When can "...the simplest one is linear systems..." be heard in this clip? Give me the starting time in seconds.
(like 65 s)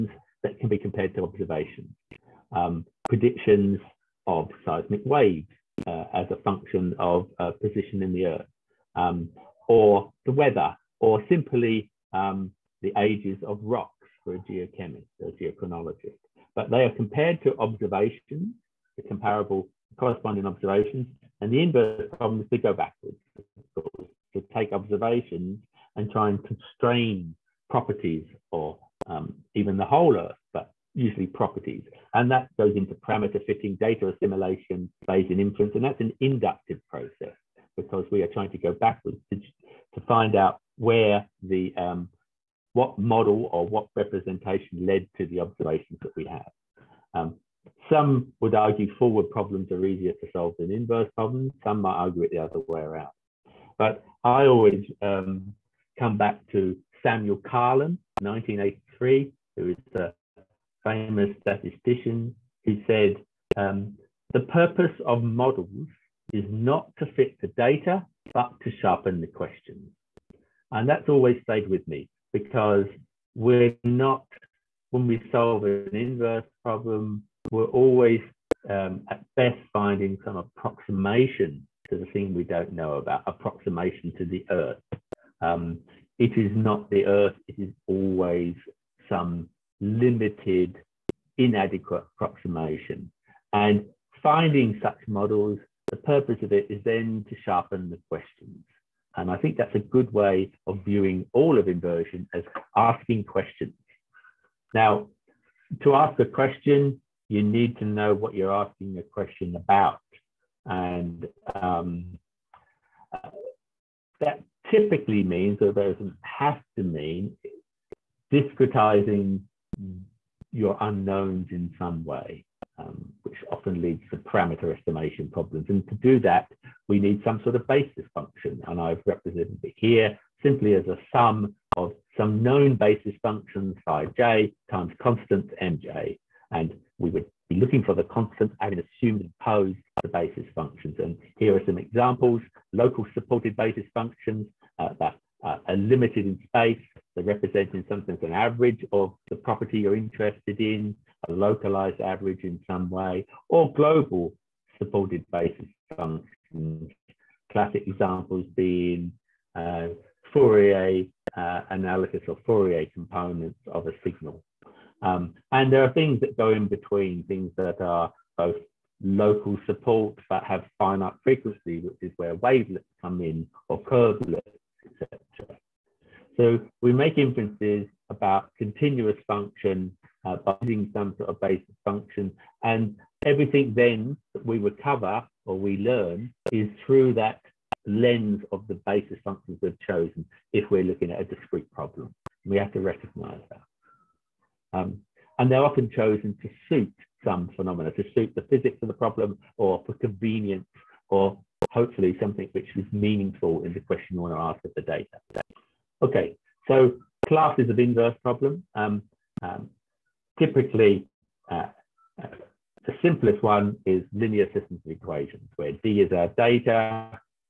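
212 s.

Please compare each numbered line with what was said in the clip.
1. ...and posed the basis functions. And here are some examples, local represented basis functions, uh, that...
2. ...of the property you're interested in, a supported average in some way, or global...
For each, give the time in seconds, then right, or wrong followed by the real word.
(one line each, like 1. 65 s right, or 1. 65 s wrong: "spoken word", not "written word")
1. 139 s wrong: "supported", not "represented"
2. 148 s wrong: "localized", not "supported".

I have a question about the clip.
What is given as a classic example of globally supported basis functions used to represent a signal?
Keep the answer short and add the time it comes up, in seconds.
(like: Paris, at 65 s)
Fourier components, at 162 s.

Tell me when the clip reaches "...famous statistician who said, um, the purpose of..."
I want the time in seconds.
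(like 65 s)
60 s.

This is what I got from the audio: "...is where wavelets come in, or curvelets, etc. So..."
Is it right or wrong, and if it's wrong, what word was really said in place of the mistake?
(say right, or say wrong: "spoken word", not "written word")
right.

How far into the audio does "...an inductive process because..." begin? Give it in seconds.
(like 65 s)
36 s.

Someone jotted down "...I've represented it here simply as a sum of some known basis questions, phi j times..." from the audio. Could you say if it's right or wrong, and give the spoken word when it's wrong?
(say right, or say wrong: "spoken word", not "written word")
wrong: "functions", not "questions".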